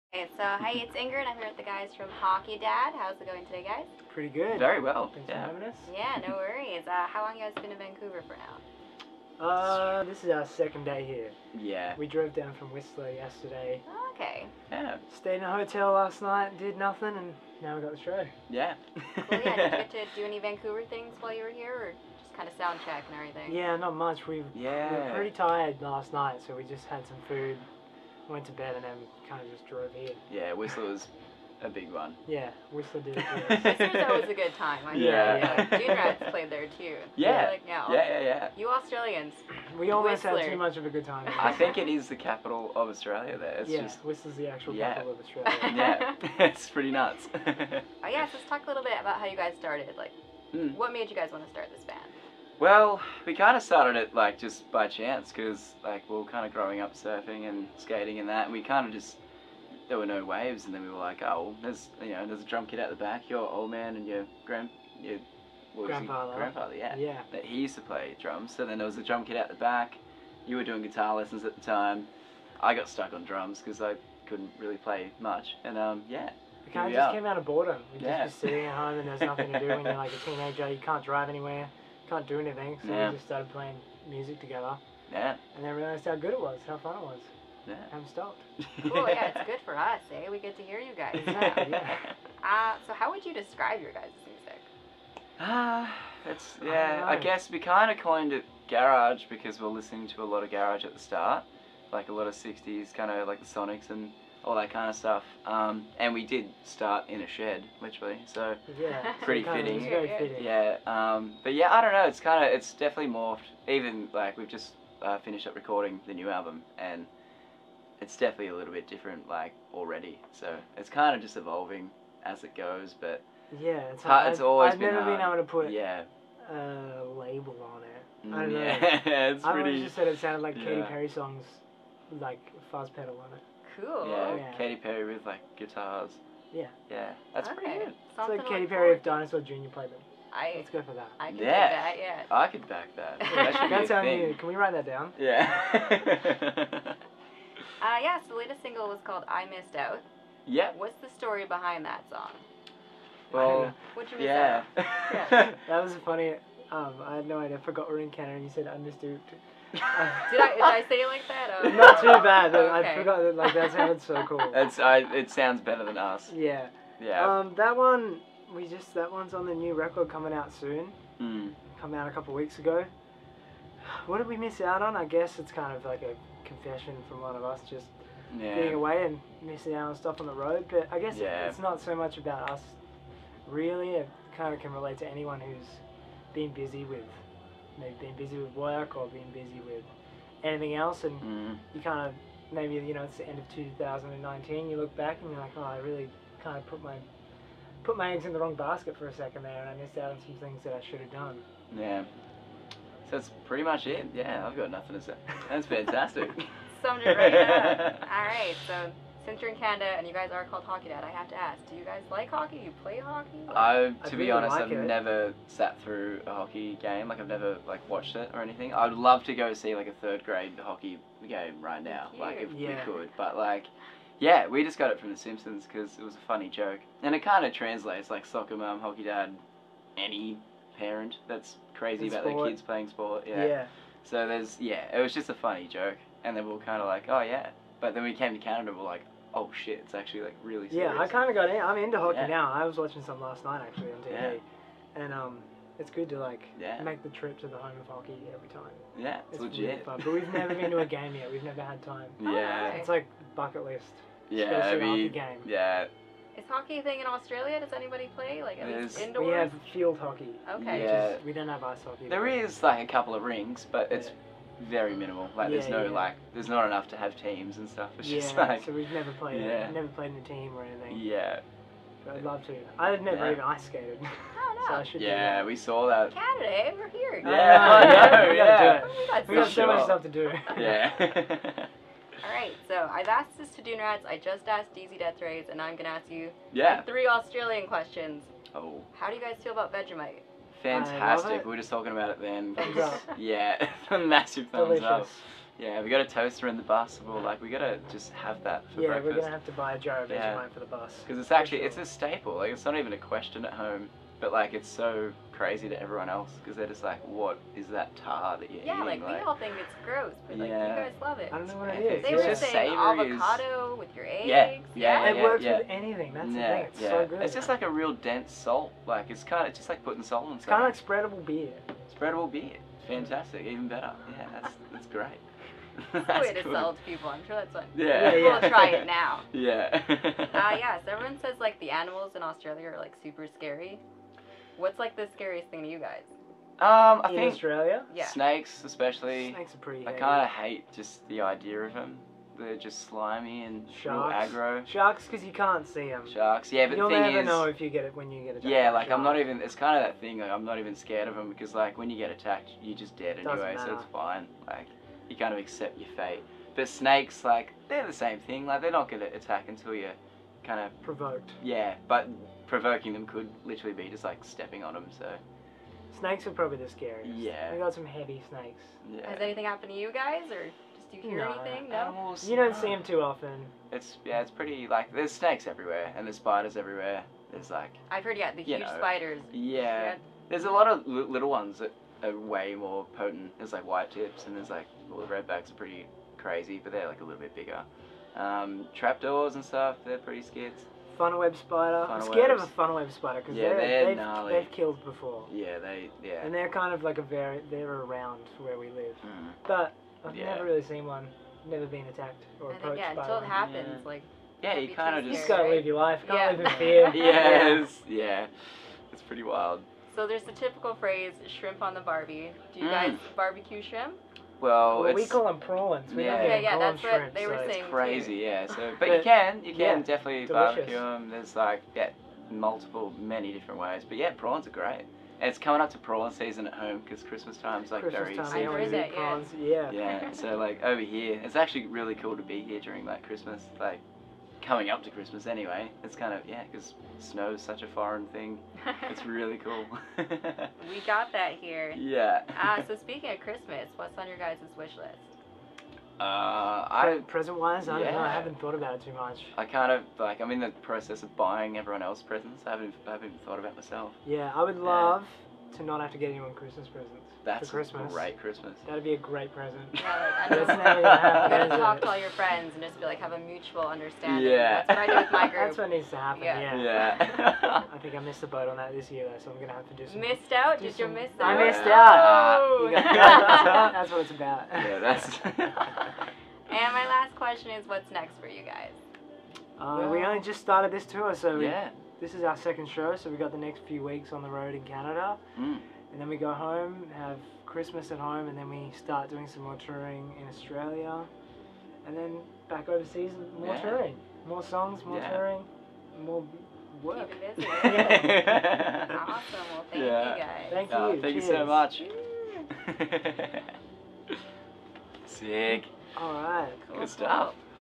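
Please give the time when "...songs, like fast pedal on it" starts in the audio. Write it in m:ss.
2:11.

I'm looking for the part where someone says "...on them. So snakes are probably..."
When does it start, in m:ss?
6:04.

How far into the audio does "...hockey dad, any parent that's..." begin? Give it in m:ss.
3:48.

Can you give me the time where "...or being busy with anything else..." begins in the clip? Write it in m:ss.
3:08.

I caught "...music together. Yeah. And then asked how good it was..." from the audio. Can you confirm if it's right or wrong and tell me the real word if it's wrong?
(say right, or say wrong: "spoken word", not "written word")
wrong: "realized", not "asked".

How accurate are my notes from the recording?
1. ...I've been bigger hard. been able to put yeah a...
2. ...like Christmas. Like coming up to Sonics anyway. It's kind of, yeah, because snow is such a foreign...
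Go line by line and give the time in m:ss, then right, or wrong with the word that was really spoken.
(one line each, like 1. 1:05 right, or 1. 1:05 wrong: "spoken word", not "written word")
1. 2:04 wrong: "never", not "bigger"
2. 7:12 wrong: "Christmas", not "Sonics".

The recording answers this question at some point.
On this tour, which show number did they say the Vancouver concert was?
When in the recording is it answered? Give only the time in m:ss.
8:02.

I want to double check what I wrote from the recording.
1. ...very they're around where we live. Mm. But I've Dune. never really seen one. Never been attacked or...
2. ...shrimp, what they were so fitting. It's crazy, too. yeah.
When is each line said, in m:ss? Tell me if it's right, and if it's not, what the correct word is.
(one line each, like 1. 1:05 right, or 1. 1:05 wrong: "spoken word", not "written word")
1. 6:37 wrong: "Yeah", not "Dune"
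2. 6:56 wrong: "saying", not "fitting".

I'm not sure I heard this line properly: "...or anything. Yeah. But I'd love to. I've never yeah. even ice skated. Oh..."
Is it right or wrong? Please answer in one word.
right.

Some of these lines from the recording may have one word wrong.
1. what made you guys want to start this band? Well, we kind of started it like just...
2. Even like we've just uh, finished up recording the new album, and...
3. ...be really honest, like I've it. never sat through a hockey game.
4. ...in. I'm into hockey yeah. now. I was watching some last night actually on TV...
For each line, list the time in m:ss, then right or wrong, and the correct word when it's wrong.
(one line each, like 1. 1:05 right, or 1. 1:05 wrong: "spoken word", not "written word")
1. 0:50 right
2. 1:53 right
3. 3:34 right
4. 4:01 right.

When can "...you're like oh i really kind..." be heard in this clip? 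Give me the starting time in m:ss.
3:15.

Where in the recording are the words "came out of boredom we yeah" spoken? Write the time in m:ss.
1:17.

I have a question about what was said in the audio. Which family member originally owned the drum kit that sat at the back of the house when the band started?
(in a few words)
Grandfather.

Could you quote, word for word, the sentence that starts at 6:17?
There's like I've heard yeah the huge know, spiders.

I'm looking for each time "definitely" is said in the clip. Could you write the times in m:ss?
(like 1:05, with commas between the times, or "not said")
1:52, 1:58, 6:59.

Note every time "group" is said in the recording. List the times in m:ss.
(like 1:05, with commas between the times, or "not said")
7:45.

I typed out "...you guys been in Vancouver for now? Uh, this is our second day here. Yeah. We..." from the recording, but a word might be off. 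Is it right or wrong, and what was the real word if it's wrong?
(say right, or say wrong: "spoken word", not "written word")
right.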